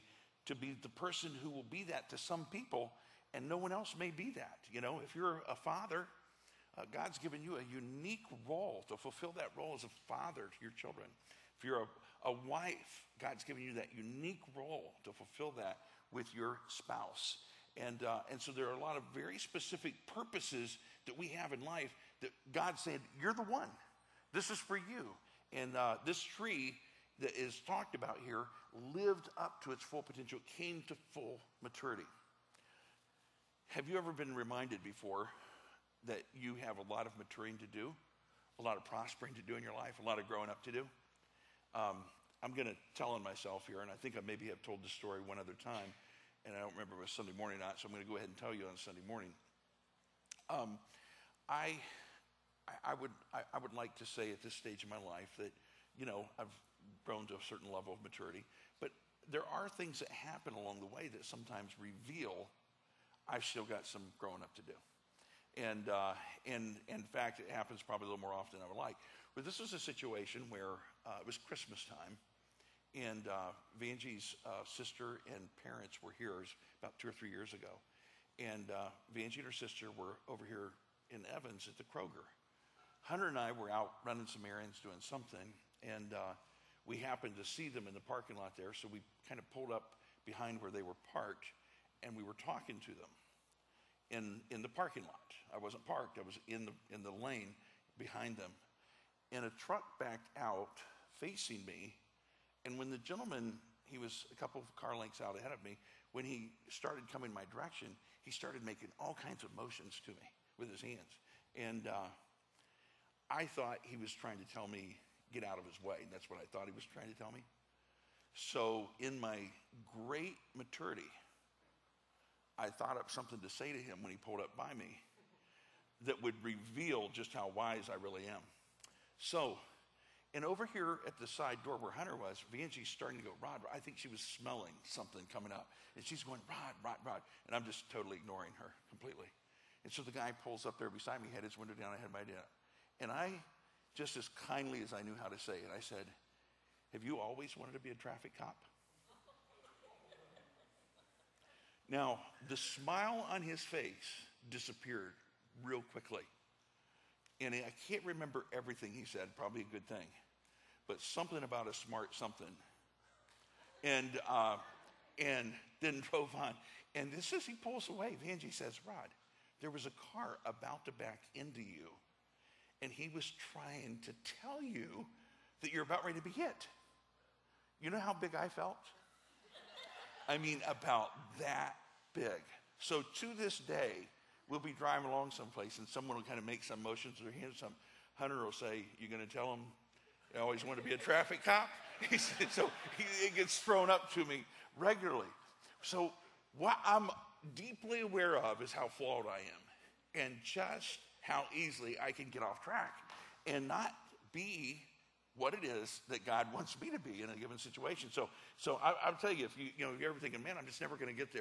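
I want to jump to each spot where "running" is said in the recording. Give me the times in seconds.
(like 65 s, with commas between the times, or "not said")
84 s.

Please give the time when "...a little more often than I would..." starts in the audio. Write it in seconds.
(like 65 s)
68 s.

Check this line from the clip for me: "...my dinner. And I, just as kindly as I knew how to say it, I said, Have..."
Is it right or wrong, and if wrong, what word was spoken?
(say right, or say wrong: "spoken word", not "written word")
right.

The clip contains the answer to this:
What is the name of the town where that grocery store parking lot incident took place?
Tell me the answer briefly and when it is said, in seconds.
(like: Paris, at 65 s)
Evans, at 81 s.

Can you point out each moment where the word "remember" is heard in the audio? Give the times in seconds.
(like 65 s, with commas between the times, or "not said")
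46 s, 158 s.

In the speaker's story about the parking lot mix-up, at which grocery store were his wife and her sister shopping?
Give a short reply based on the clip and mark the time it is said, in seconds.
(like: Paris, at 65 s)
Kroger, at 81 s.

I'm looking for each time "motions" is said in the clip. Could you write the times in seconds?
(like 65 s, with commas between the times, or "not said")
109 s, 186 s.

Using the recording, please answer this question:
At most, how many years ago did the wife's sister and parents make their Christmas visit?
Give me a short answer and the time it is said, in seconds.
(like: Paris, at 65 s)
3, at 77 s.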